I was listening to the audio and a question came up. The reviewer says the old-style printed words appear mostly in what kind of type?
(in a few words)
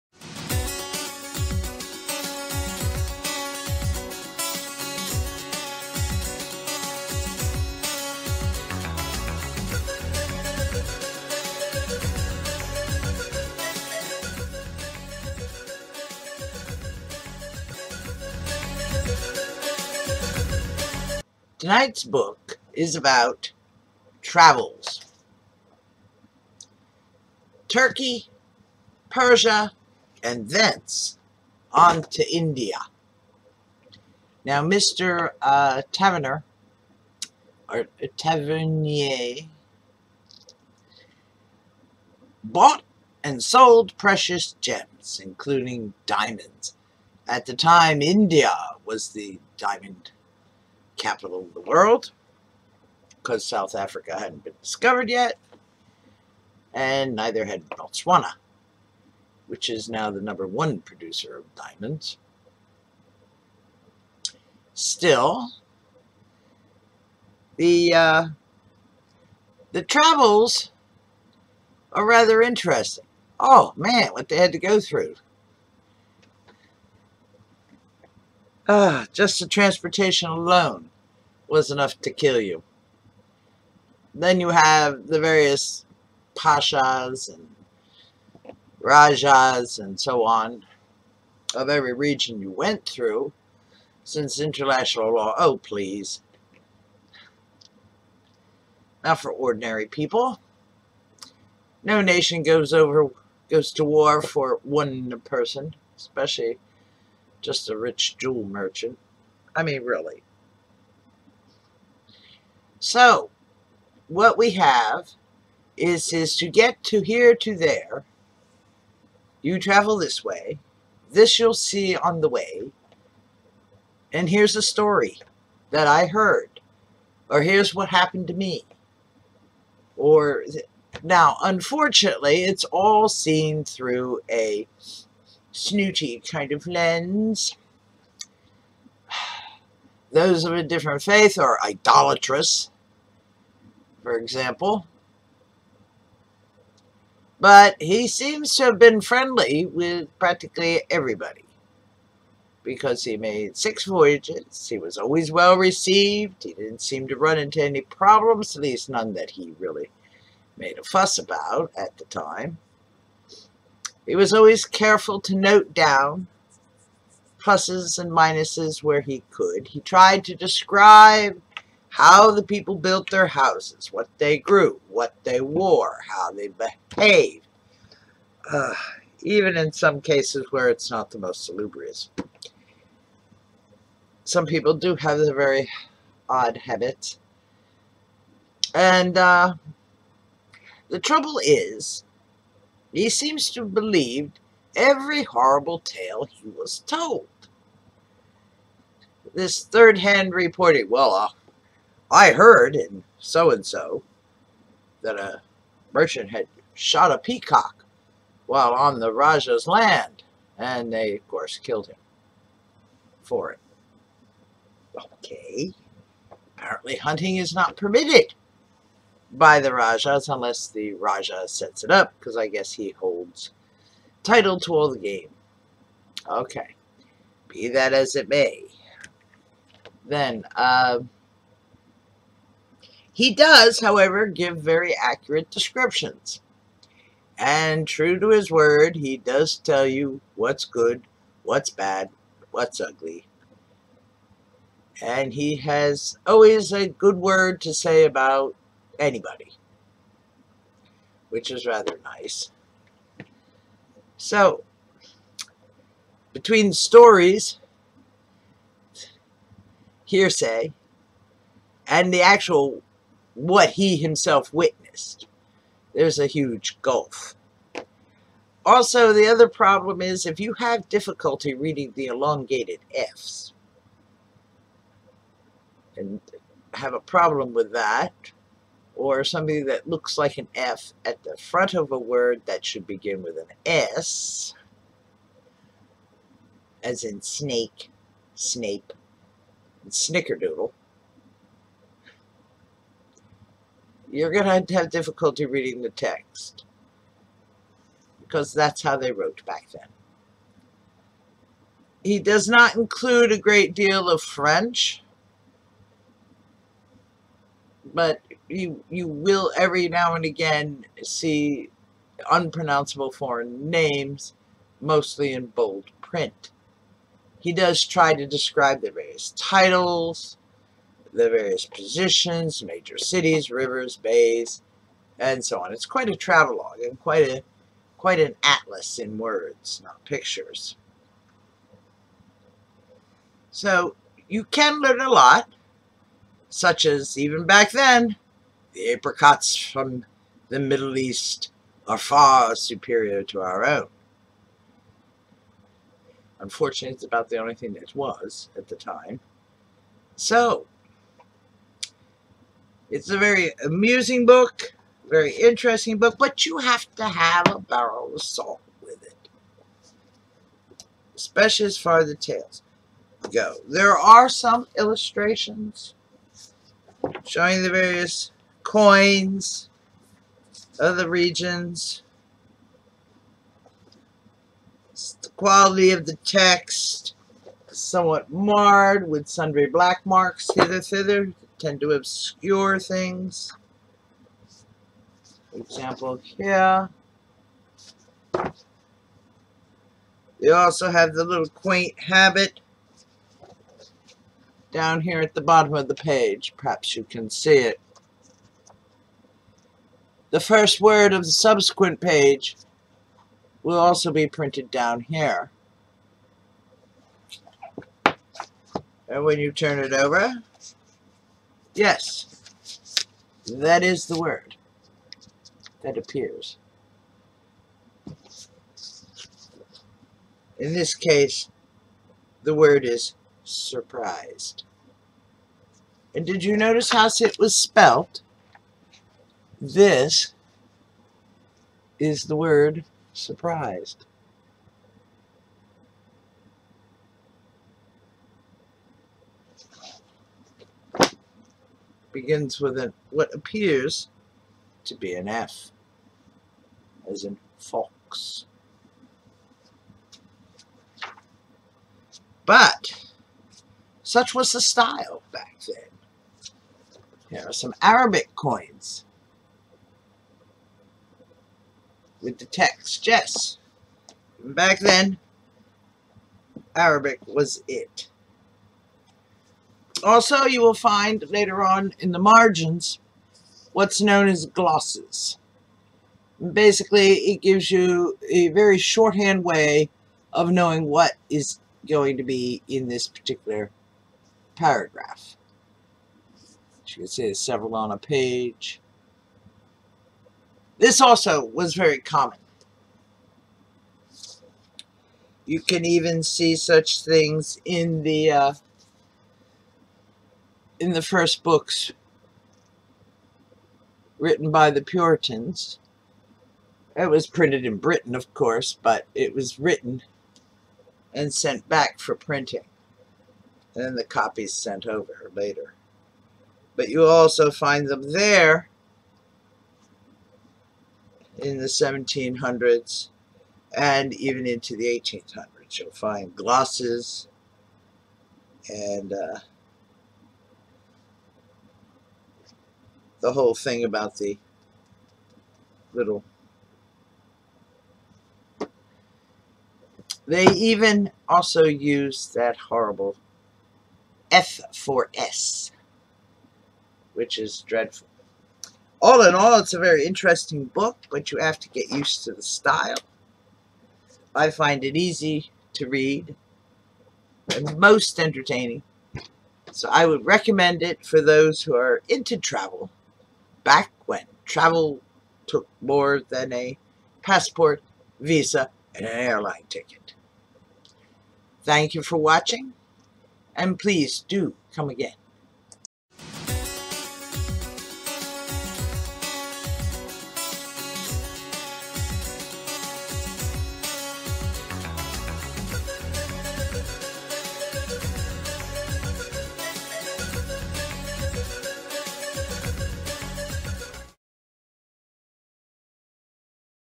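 bold print.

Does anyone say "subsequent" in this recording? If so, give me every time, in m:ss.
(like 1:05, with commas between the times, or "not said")
6:41.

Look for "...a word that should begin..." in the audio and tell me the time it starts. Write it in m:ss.
4:41.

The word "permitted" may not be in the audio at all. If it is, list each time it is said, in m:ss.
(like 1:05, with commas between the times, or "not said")
3:37.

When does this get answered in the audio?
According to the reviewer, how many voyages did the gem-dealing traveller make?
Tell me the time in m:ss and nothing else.
2:33.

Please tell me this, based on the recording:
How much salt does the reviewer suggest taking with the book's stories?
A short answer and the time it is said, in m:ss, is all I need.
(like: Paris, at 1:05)
a barrel, at 5:57.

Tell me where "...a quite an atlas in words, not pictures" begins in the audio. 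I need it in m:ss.
5:27.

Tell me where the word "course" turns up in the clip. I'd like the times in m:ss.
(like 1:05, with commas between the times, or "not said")
3:31, 8:28.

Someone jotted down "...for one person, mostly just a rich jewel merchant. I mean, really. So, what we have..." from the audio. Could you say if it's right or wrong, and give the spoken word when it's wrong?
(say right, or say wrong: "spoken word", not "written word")
wrong: "especially", not "mostly".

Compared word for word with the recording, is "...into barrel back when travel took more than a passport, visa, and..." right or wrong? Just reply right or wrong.
wrong.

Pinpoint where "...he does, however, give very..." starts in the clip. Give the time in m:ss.
3:53.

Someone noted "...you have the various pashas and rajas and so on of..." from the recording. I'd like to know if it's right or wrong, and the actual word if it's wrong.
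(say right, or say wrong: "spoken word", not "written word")
right.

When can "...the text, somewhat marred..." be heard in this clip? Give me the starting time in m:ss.
6:16.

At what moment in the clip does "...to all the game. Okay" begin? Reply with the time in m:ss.
3:44.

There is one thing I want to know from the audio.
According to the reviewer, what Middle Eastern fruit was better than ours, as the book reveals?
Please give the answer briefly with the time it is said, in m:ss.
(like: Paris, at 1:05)
apricots, at 5:38.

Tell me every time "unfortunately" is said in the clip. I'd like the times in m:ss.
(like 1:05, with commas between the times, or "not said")
2:11, 5:46.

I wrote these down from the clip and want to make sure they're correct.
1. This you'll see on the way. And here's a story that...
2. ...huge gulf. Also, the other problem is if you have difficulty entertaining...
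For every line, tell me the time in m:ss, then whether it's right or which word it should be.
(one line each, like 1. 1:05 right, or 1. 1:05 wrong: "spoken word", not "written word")
1. 2:01 right
2. 4:26 wrong: "reading", not "entertaining".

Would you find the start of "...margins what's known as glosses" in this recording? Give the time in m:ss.
7:52.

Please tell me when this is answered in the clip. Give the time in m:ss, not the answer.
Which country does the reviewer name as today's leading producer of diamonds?
0:57.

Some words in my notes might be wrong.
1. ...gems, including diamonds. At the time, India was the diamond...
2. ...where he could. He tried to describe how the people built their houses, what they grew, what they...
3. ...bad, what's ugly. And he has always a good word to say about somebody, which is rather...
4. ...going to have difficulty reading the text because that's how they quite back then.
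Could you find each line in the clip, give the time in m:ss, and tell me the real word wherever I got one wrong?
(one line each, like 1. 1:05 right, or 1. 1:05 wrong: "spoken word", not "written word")
1. 0:44 right
2. 2:48 right
3. 4:01 wrong: "anybody", not "somebody"
4. 4:54 wrong: "wrote", not "quite".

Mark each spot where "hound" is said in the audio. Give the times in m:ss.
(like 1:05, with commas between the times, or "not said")
not said.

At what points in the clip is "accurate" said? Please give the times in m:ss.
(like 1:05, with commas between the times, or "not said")
3:54.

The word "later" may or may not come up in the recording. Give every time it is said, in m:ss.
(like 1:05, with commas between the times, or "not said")
7:51, 8:35.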